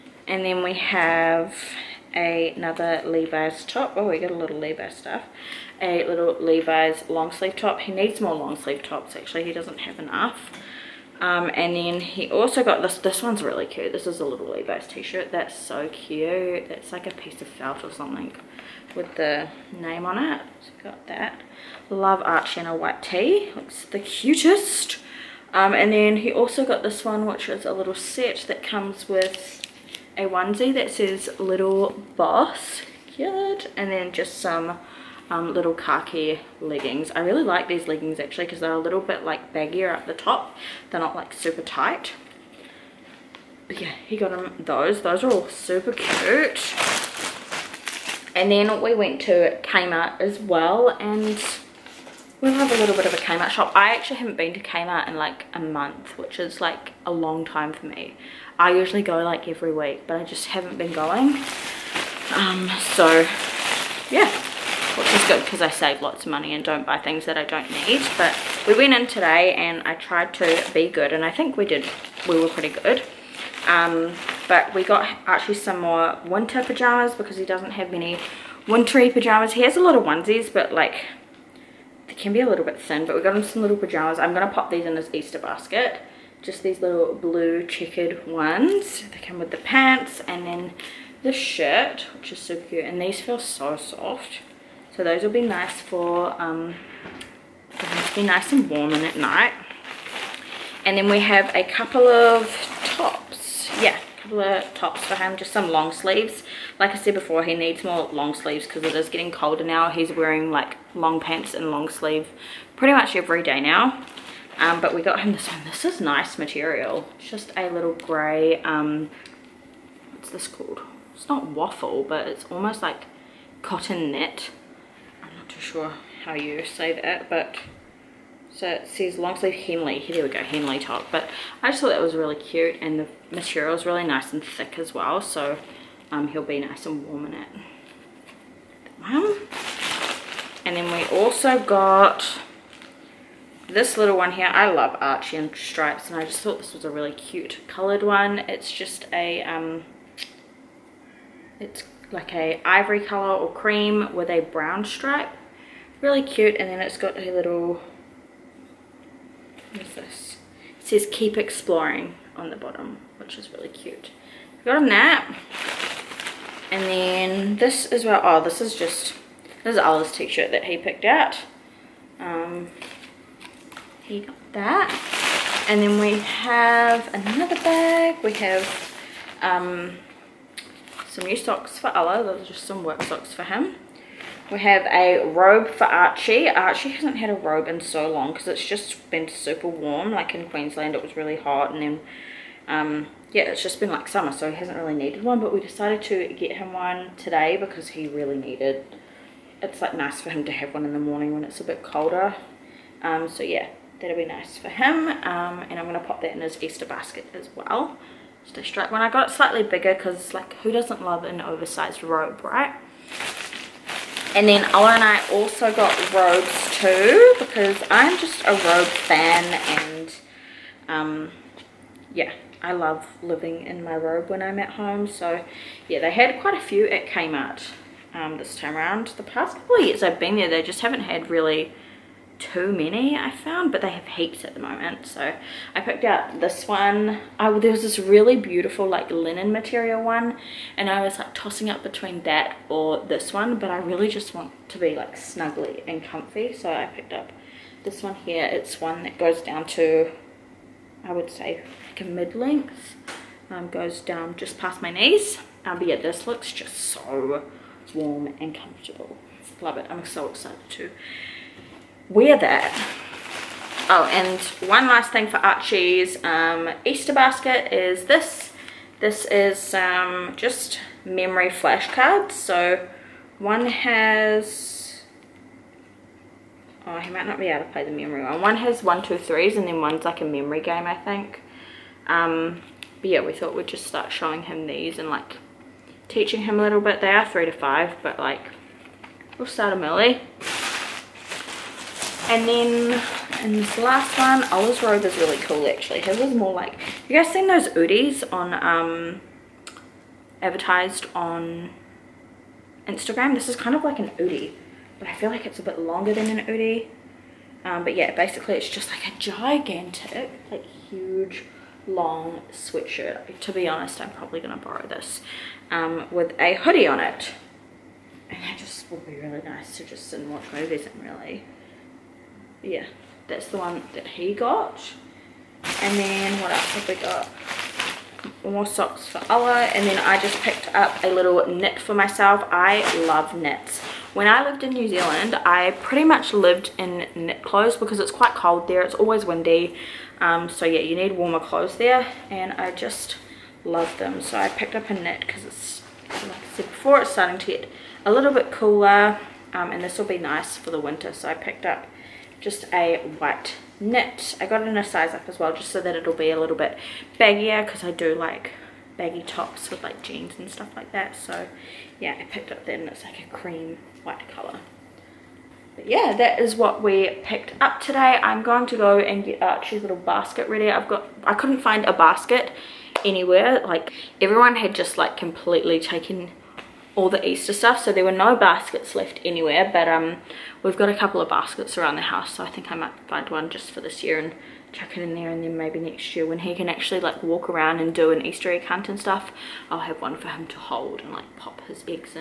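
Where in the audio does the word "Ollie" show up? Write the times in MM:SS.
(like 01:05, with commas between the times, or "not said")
02:49, 04:54, 05:29.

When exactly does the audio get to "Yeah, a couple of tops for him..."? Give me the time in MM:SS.
01:43.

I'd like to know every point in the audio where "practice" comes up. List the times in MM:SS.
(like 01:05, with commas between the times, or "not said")
not said.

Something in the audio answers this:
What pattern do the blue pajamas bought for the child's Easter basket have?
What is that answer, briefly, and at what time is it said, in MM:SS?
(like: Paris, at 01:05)
Checkered, at 01:27.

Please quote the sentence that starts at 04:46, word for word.
They are three to five, but like we'll start him early.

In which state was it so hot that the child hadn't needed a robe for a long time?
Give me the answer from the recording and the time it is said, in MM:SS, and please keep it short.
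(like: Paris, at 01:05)
Queensland, at 03:10.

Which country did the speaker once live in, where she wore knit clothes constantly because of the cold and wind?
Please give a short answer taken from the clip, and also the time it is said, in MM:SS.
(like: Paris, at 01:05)
New Zealand, at 05:34.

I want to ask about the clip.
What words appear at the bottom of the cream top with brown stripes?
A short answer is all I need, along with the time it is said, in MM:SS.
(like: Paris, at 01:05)
Keep exploring, at 02:41.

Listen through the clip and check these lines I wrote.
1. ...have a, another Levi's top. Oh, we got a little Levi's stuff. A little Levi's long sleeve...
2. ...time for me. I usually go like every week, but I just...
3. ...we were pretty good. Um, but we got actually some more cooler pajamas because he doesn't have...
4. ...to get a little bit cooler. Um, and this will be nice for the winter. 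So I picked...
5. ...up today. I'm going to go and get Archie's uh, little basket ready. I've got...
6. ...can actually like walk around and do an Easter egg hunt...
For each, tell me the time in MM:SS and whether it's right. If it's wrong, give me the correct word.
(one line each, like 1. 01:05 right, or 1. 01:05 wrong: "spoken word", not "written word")
1. 00:00 right
2. 00:57 right
3. 01:12 wrong: "winter", not "cooler"
4. 05:47 right
5. 06:07 right
6. 06:26 right.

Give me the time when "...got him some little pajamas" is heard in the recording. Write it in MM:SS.
01:23.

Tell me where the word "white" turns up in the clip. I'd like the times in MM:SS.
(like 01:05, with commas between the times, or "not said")
00:22, 05:53, 06:04.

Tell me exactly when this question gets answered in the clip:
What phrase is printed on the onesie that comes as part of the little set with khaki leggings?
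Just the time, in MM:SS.
00:31.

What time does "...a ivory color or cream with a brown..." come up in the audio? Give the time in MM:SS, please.
02:32.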